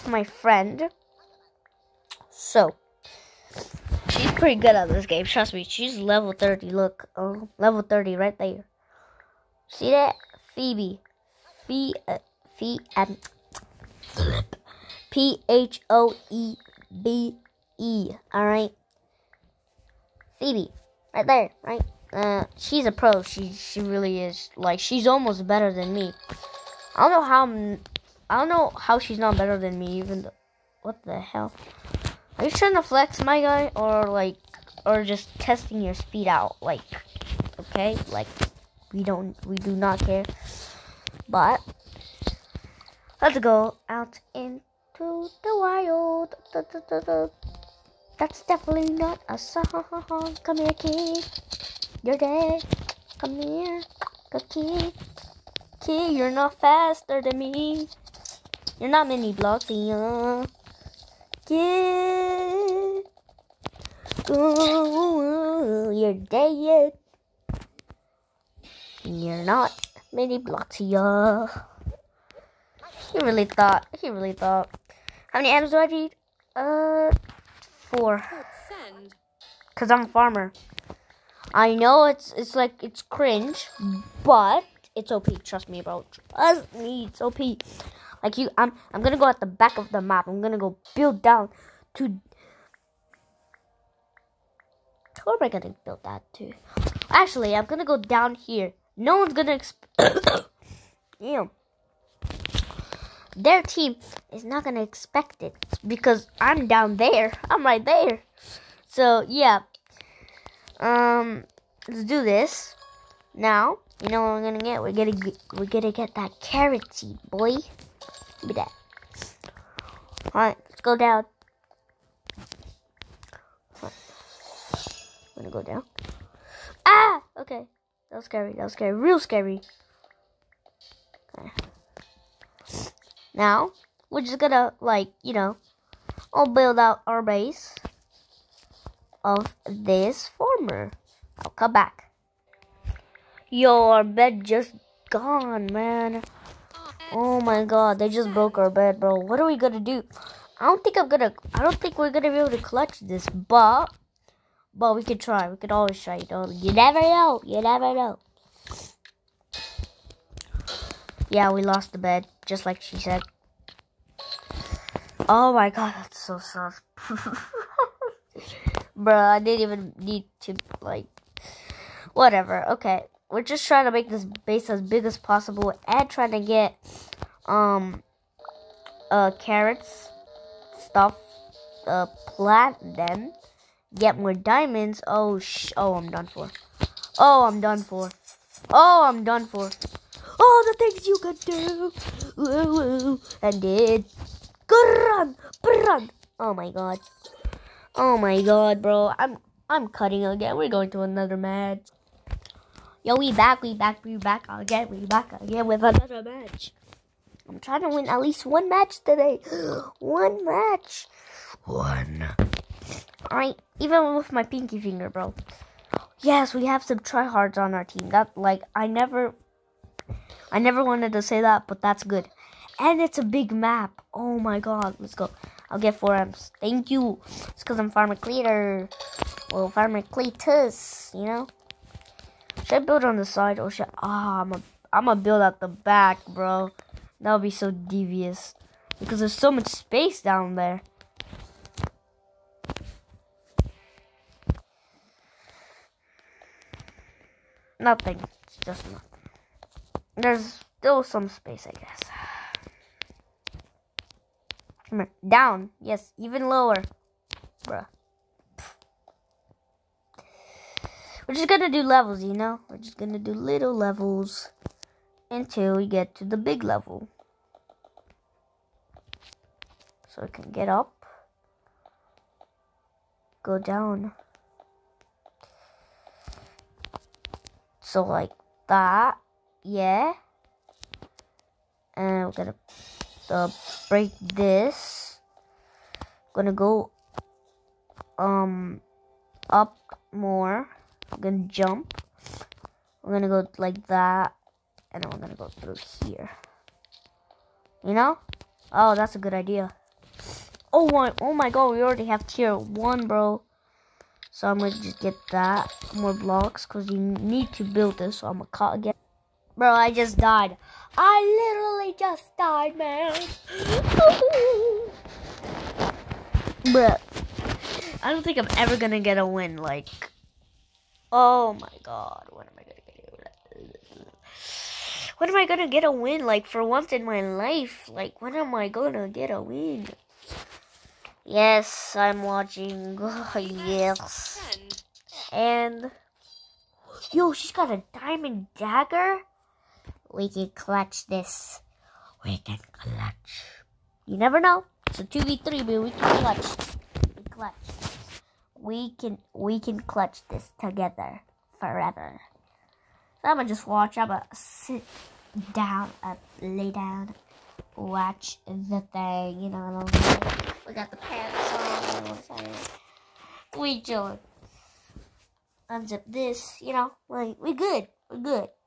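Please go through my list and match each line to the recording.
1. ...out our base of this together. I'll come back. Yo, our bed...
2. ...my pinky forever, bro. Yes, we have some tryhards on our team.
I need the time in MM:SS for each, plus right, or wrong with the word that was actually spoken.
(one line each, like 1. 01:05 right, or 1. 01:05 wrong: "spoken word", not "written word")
1. 02:16 wrong: "farmer", not "together"
2. 03:34 wrong: "finger", not "forever".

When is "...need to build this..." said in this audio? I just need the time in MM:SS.
05:06.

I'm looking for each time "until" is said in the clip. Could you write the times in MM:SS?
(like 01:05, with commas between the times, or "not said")
04:25.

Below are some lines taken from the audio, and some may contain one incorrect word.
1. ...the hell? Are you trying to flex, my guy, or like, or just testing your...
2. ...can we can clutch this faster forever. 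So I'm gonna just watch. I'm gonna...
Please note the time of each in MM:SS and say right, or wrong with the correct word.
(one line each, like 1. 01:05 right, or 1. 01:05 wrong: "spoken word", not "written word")
1. 00:31 right
2. 05:48 wrong: "together", not "faster".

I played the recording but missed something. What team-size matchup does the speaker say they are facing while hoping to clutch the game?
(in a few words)
2v3.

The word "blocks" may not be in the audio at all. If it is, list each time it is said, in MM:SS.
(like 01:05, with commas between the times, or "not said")
00:59, 01:10, 05:06.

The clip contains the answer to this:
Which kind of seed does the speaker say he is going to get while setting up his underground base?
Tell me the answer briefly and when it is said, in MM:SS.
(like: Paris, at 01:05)
Carrot seed, at 01:56.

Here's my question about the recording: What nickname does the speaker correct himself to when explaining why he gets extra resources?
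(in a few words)
Farmer Cletus.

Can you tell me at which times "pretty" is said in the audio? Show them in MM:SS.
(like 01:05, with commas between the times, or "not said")
00:04.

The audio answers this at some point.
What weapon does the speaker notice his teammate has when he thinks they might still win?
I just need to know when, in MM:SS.
05:37.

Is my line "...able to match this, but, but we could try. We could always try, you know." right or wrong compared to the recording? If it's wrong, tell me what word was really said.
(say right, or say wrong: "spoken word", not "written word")
wrong: "clutch", not "match".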